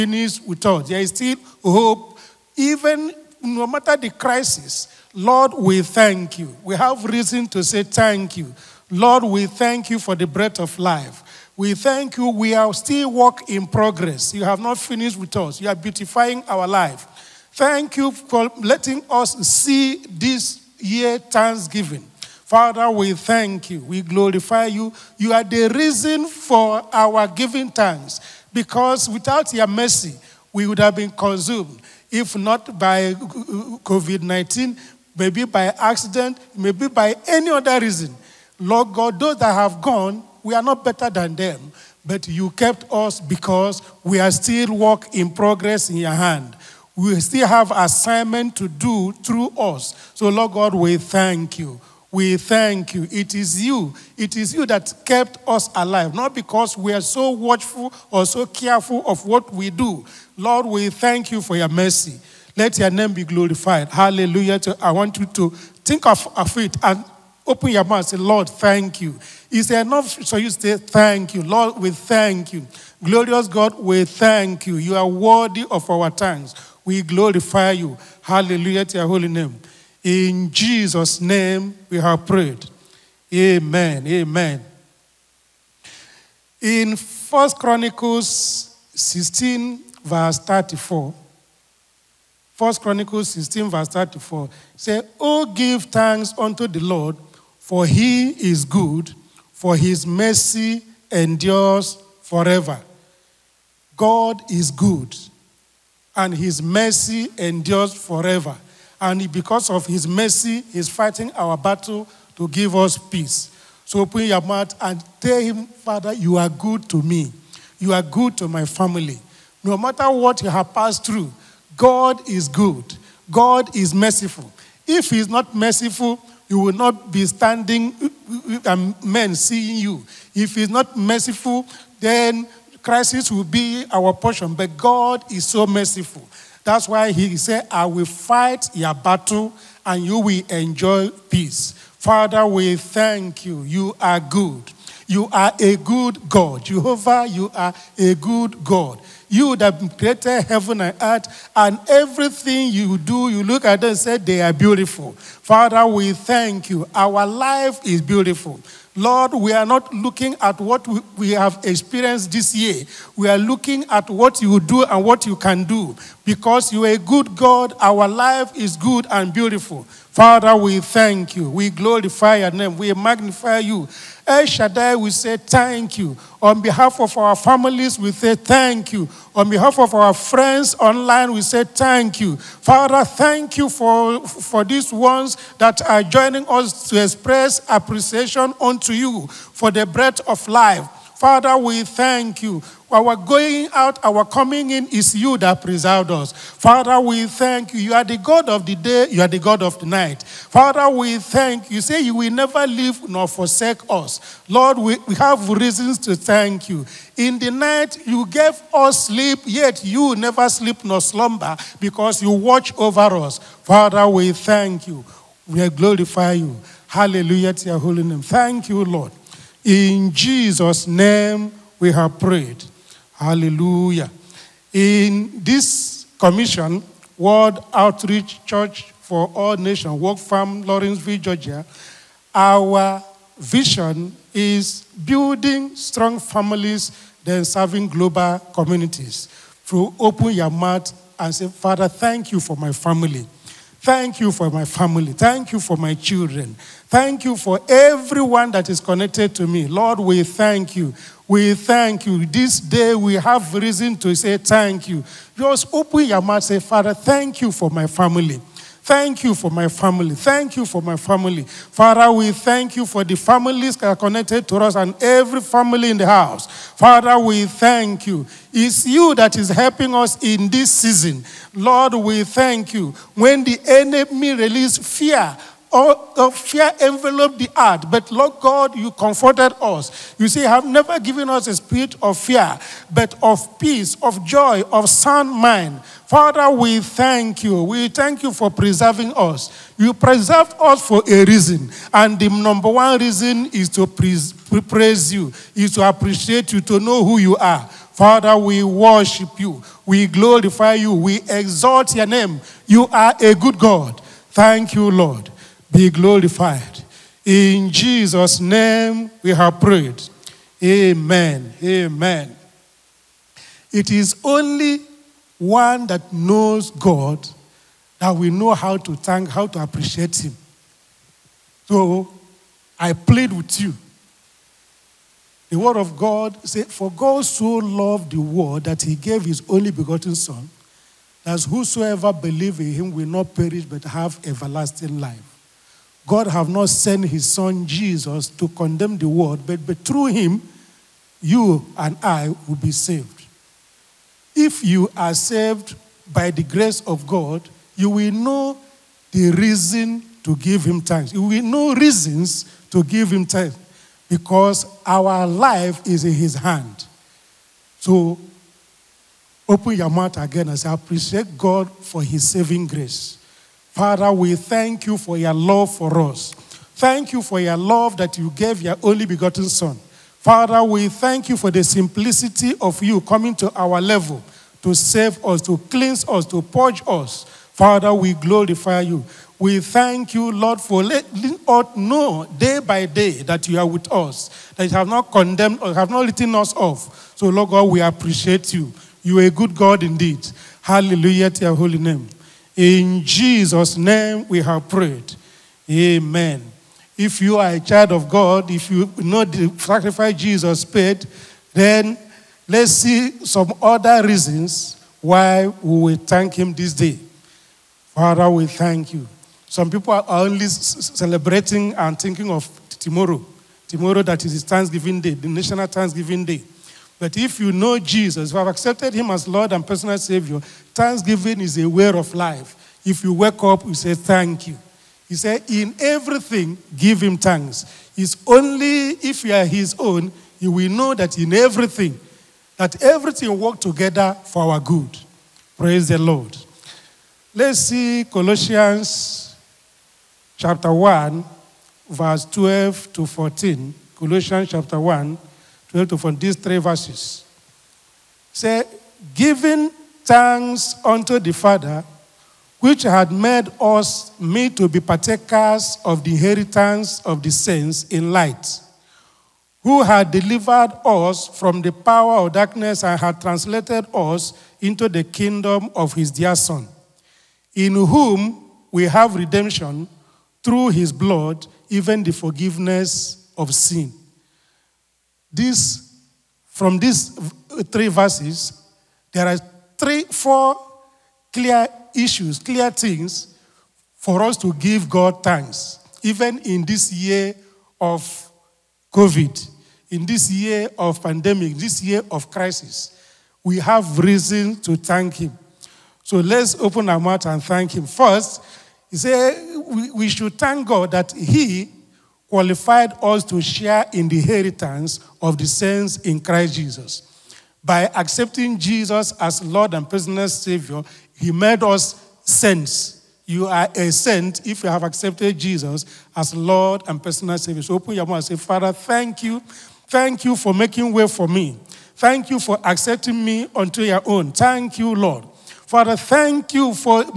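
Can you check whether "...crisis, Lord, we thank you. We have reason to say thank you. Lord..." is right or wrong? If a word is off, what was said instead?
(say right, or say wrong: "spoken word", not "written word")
right.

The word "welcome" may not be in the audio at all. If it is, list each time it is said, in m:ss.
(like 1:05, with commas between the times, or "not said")
not said.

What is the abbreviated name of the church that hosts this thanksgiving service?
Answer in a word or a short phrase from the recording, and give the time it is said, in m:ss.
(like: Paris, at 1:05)
WOCFAN, at 3:49.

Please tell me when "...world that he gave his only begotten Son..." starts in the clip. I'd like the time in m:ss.
5:28.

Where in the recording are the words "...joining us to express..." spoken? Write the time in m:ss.
3:06.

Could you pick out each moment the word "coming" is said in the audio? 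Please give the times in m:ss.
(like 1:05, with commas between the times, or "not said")
3:14, 6:12.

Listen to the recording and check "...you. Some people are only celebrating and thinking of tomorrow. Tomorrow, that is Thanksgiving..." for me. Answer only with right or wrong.
right.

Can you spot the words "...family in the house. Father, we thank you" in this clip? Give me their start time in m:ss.
4:25.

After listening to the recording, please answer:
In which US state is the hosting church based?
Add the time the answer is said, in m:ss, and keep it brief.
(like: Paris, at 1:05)
Georgia, at 3:51.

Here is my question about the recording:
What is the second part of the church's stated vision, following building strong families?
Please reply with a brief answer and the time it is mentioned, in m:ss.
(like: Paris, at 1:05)
serving global communities, at 3:57.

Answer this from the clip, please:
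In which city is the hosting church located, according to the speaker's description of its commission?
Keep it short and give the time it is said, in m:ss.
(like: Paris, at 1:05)
Lawrenceville, at 3:50.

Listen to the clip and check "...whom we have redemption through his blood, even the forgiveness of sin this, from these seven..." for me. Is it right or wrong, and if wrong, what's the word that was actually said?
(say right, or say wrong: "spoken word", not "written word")
wrong: "three", not "seven".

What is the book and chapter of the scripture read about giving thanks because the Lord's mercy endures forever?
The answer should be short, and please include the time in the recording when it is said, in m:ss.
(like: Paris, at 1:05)
1 Chronicles 16, at 1:26.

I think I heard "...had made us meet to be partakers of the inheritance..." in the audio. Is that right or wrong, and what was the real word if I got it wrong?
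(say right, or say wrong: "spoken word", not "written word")
right.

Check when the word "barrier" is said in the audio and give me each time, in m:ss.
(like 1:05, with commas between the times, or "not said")
not said.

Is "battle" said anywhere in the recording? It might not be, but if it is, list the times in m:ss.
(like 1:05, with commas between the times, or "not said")
1:51, 2:18.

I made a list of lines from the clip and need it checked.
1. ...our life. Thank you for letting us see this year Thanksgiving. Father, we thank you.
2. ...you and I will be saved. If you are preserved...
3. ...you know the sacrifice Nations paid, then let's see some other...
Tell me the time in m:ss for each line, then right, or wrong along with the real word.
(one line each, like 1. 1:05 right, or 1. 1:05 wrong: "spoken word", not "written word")
1. 0:16 right
2. 5:41 wrong: "saved", not "preserved"
3. 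6:38 wrong: "Jesus", not "Nations".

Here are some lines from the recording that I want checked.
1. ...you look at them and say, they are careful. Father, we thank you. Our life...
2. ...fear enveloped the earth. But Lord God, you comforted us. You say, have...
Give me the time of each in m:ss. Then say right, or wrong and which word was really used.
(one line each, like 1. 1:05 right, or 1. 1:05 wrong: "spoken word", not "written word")
1. 2:33 wrong: "beautiful", not "careful"
2. 4:36 right.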